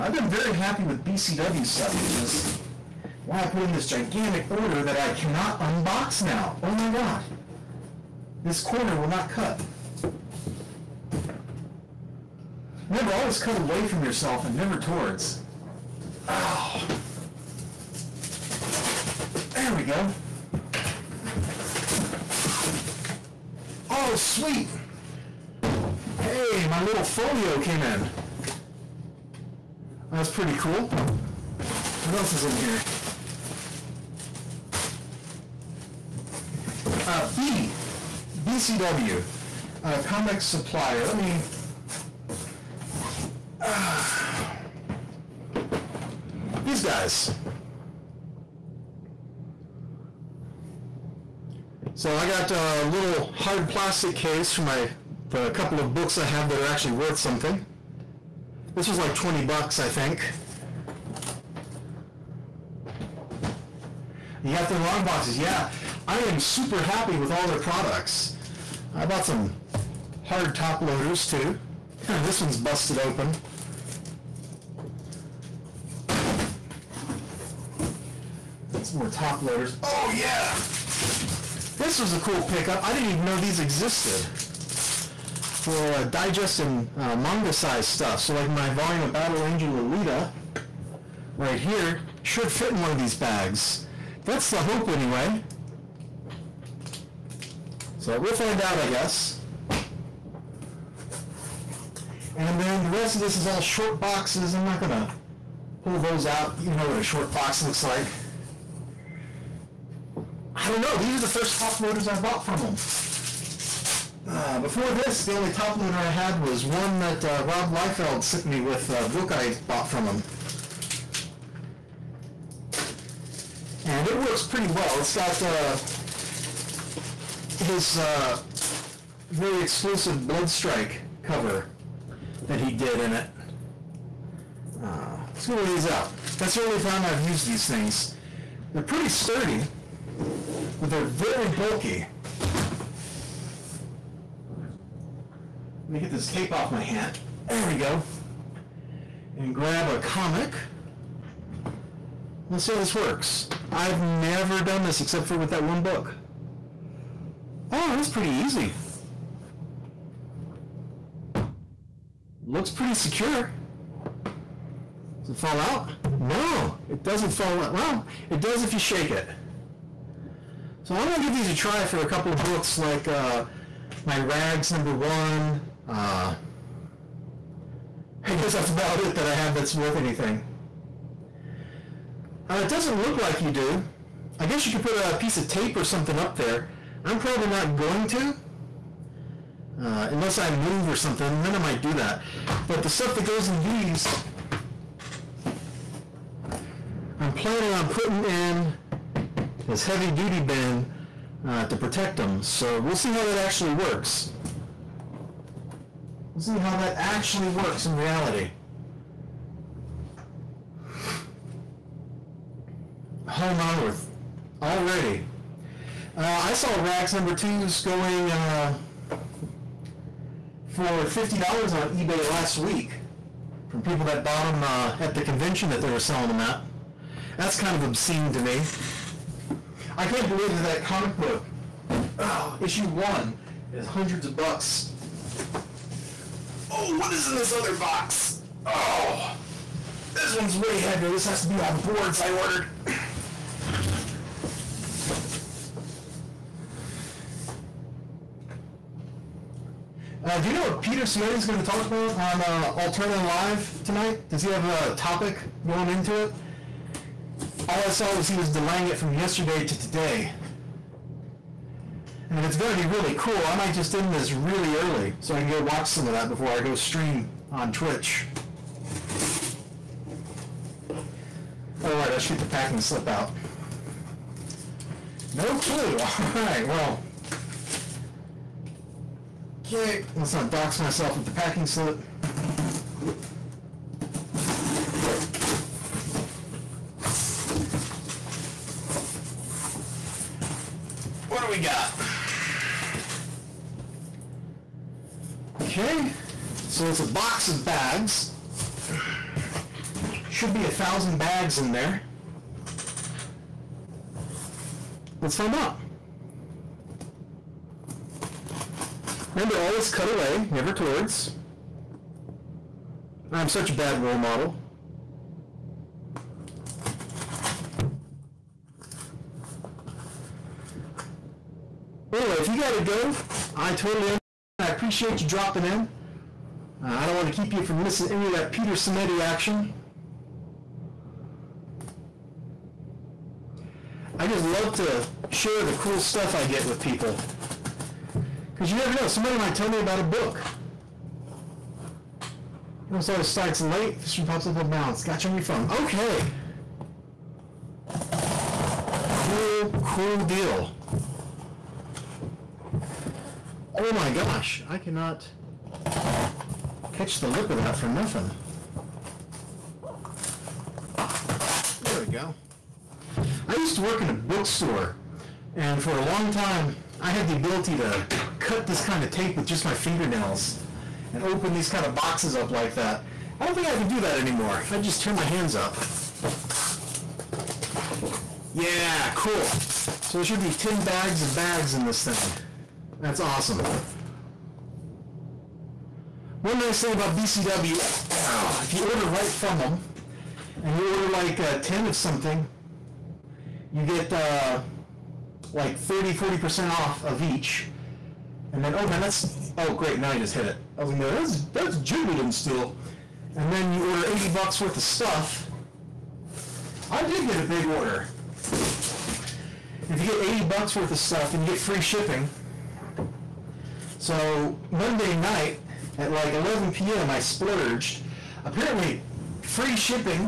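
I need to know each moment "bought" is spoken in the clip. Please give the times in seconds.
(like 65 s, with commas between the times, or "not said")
69 s, 112 s, 119 s, 224 s.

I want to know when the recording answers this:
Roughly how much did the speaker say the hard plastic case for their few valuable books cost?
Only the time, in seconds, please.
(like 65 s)
59 s.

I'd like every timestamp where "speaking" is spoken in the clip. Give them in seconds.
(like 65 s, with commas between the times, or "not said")
not said.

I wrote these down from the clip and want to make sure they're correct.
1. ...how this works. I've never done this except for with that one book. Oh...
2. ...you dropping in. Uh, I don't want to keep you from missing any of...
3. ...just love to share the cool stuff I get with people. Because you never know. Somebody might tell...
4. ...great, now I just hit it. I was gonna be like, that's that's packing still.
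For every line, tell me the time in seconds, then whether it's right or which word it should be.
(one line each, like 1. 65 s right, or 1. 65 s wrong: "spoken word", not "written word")
1. 152 s right
2. 325 s right
3. 334 s right
4. 399 s wrong: "jiggling", not "packing".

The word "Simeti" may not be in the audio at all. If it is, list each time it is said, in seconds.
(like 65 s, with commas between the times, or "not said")
251 s, 328 s.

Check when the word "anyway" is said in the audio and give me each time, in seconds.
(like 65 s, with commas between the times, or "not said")
94 s, 322 s.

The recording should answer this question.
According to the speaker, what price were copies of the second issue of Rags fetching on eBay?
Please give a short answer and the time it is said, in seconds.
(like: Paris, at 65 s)
$50, at 221 s.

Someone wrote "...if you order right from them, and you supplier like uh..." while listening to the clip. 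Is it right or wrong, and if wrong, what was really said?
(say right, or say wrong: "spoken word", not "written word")
wrong: "order", not "supplier".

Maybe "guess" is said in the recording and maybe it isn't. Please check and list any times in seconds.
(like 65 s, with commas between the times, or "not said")
98 s, 178 s, 184 s.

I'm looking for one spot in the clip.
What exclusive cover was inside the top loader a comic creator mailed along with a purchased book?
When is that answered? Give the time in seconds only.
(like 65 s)
130 s.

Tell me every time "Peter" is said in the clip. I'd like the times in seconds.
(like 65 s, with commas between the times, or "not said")
250 s, 328 s.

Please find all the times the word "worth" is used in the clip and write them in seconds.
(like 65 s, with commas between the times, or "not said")
56 s, 179 s, 404 s, 410 s.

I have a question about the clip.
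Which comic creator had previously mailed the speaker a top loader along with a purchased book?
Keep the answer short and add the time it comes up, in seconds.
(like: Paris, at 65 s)
Rob Liefeld, at 117 s.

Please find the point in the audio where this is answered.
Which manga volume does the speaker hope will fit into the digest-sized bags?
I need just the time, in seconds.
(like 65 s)
89 s.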